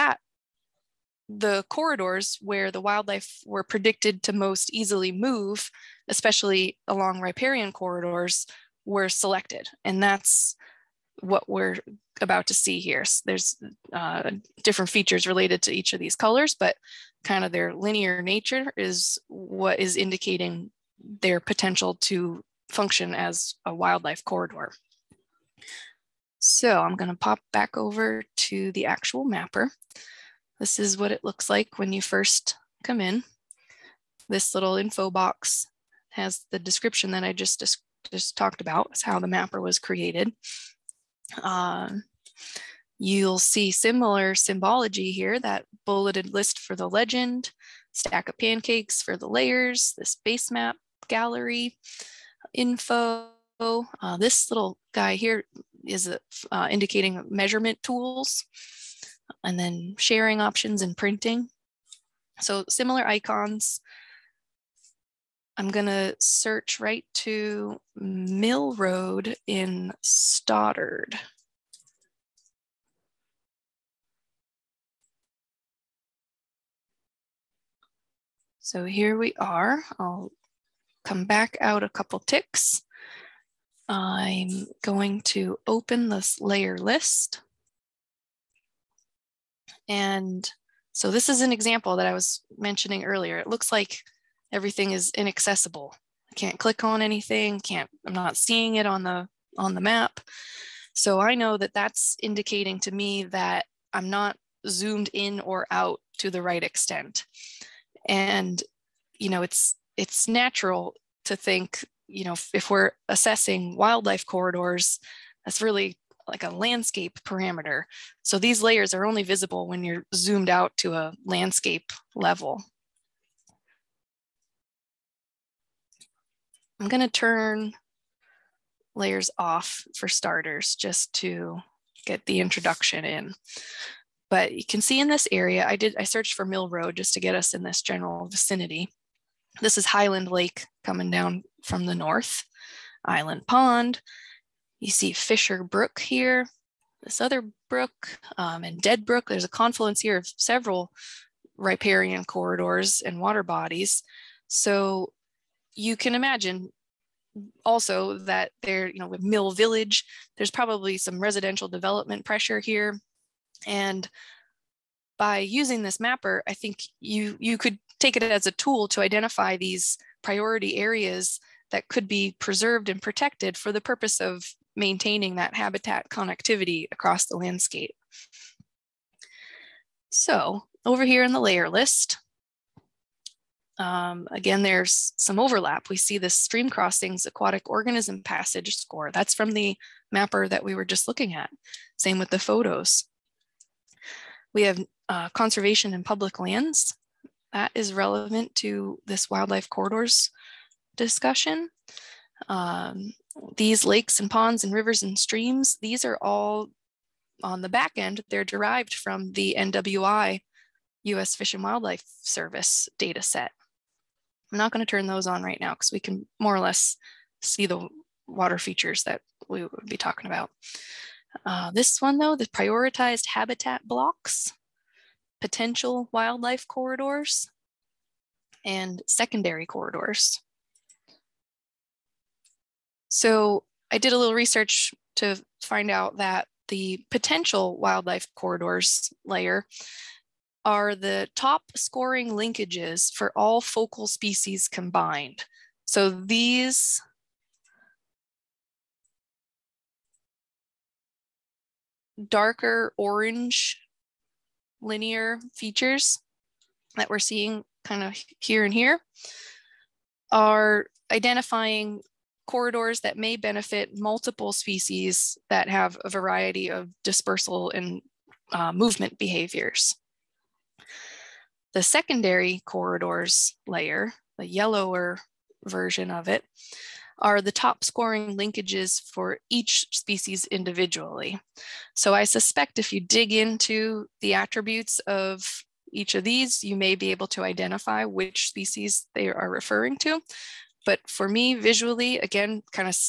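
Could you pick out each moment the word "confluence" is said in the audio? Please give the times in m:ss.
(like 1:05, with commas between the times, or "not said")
2:29.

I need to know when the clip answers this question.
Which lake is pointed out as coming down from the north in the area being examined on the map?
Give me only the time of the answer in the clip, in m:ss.
2:19.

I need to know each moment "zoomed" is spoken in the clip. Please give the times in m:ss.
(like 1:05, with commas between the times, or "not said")
1:44, 2:00.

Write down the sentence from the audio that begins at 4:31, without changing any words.
The secondary corridors layer, the yellower version of it, are the top scoring linkages for each species individually.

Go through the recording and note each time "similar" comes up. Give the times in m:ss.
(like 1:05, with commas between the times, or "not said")
0:43, 1:02.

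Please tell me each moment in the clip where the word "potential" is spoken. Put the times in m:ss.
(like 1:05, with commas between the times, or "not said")
0:21, 3:45, 3:57.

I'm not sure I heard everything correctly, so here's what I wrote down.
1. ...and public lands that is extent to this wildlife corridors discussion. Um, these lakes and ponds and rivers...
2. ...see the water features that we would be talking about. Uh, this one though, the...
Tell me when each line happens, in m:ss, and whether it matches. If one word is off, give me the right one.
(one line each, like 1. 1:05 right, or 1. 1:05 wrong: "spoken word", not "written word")
1. 3:15 wrong: "relevant", not "extent"
2. 3:37 right.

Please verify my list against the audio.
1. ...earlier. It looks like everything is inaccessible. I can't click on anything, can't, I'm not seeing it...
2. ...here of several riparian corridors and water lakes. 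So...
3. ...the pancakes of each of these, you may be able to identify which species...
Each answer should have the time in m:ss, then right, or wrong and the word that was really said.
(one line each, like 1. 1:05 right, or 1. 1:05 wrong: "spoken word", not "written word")
1. 1:33 right
2. 2:30 wrong: "bodies", not "lakes"
3. 4:44 wrong: "attributes", not "pancakes".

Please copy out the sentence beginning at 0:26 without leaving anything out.
So I'm going to pop back over to the actual mapper.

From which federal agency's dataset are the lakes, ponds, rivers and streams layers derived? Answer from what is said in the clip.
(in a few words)
US Fish and Wildlife Service.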